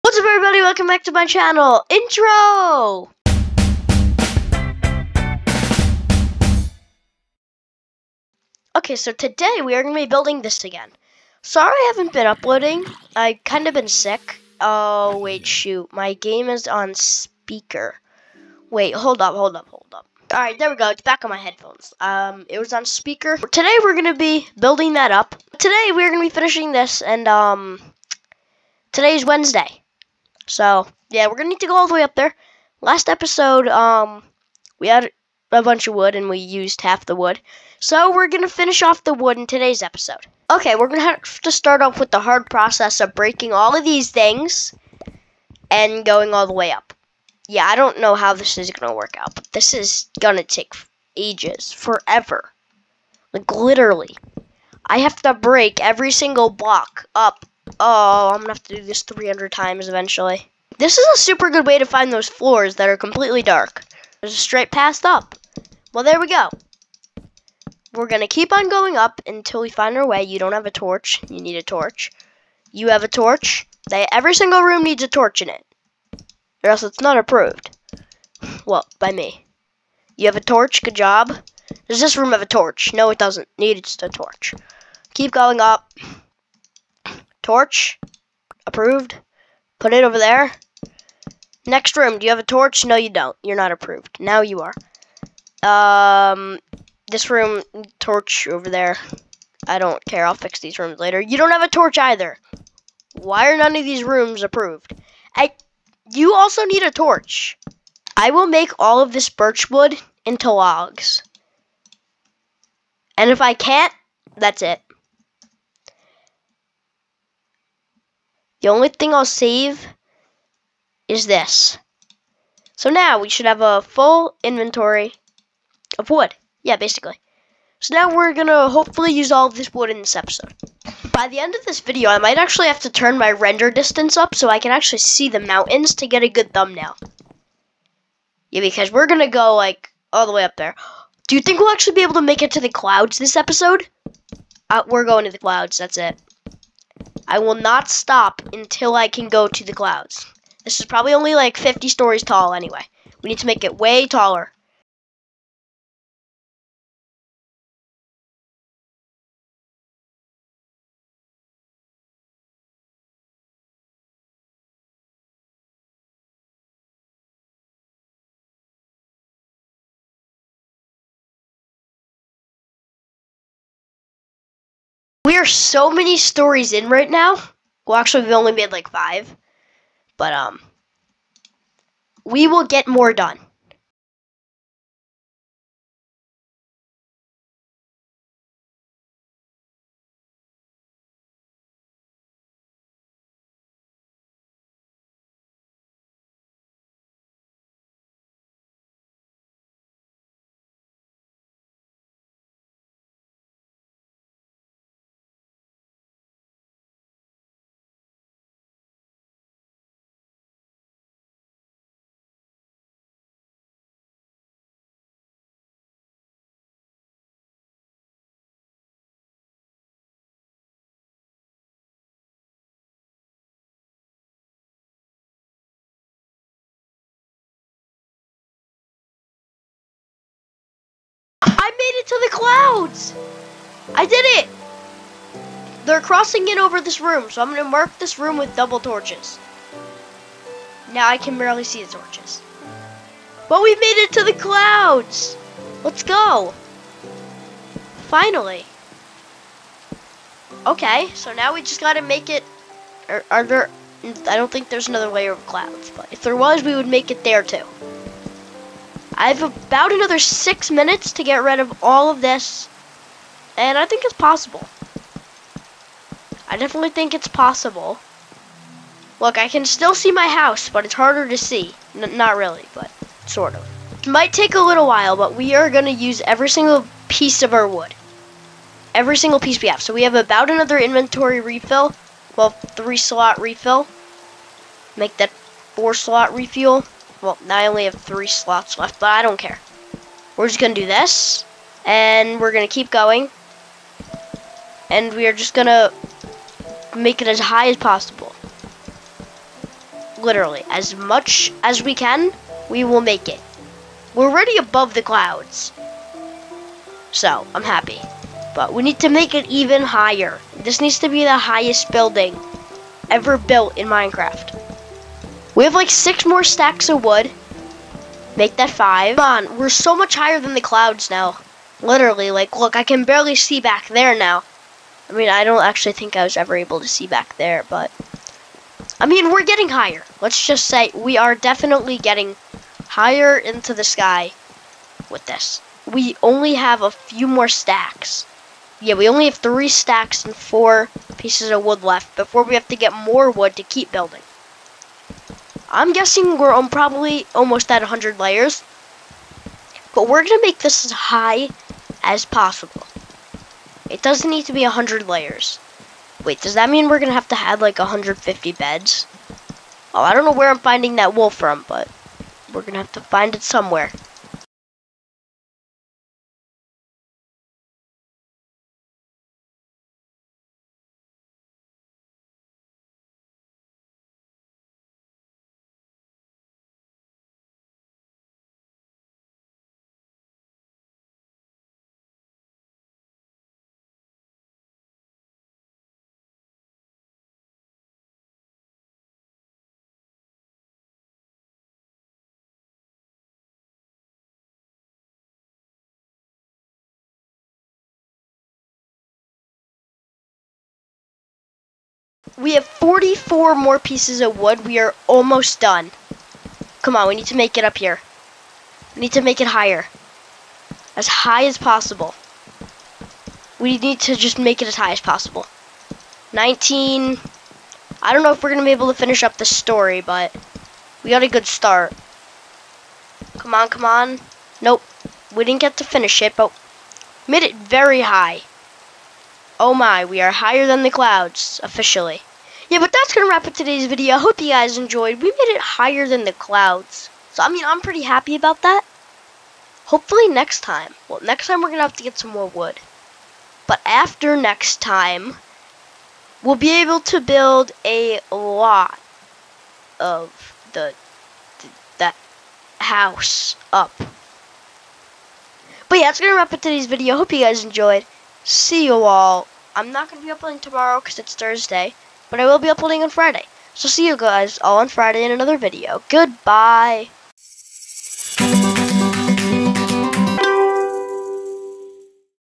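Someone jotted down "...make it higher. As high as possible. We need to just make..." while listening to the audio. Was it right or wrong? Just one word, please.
right.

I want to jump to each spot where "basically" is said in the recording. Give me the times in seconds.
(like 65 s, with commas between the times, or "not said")
126 s.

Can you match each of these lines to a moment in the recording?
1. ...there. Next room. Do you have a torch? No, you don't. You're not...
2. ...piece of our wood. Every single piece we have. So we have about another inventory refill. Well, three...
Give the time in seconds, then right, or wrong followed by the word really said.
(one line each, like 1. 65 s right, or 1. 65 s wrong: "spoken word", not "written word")
1. 90 s right
2. 277 s right.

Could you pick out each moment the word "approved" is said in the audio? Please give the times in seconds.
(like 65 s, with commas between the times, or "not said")
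77 s, 88 s, 93 s, 104 s.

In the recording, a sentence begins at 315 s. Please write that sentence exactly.
We have like six more stacks of wood.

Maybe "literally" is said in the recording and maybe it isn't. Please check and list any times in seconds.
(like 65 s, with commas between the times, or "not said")
53 s, 300 s, 321 s.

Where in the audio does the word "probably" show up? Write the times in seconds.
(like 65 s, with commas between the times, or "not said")
150 s, 346 s.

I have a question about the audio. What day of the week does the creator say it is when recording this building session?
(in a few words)
Wednesday.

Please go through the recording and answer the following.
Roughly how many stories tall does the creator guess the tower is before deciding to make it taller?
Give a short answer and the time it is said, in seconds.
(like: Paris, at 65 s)
50, at 151 s.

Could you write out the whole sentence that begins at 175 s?
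We are so many stories in right now.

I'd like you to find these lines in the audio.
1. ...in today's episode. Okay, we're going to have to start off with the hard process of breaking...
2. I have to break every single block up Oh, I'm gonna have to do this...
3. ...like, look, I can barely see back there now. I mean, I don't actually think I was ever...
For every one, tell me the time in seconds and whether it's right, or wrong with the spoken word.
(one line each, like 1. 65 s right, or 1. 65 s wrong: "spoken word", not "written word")
1. 39 s right
2. 54 s right
3. 322 s right.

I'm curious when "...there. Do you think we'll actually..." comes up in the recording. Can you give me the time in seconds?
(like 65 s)
140 s.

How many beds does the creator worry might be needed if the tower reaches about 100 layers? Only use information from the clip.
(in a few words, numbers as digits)
150.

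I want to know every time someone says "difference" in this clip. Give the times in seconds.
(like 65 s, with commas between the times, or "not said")
not said.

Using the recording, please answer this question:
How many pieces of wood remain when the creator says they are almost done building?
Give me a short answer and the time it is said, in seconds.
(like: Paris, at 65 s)
44, at 402 s.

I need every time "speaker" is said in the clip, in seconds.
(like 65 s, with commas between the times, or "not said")
16 s, 22 s.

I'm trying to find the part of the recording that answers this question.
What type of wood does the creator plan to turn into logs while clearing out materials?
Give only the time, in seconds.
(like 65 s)
109 s.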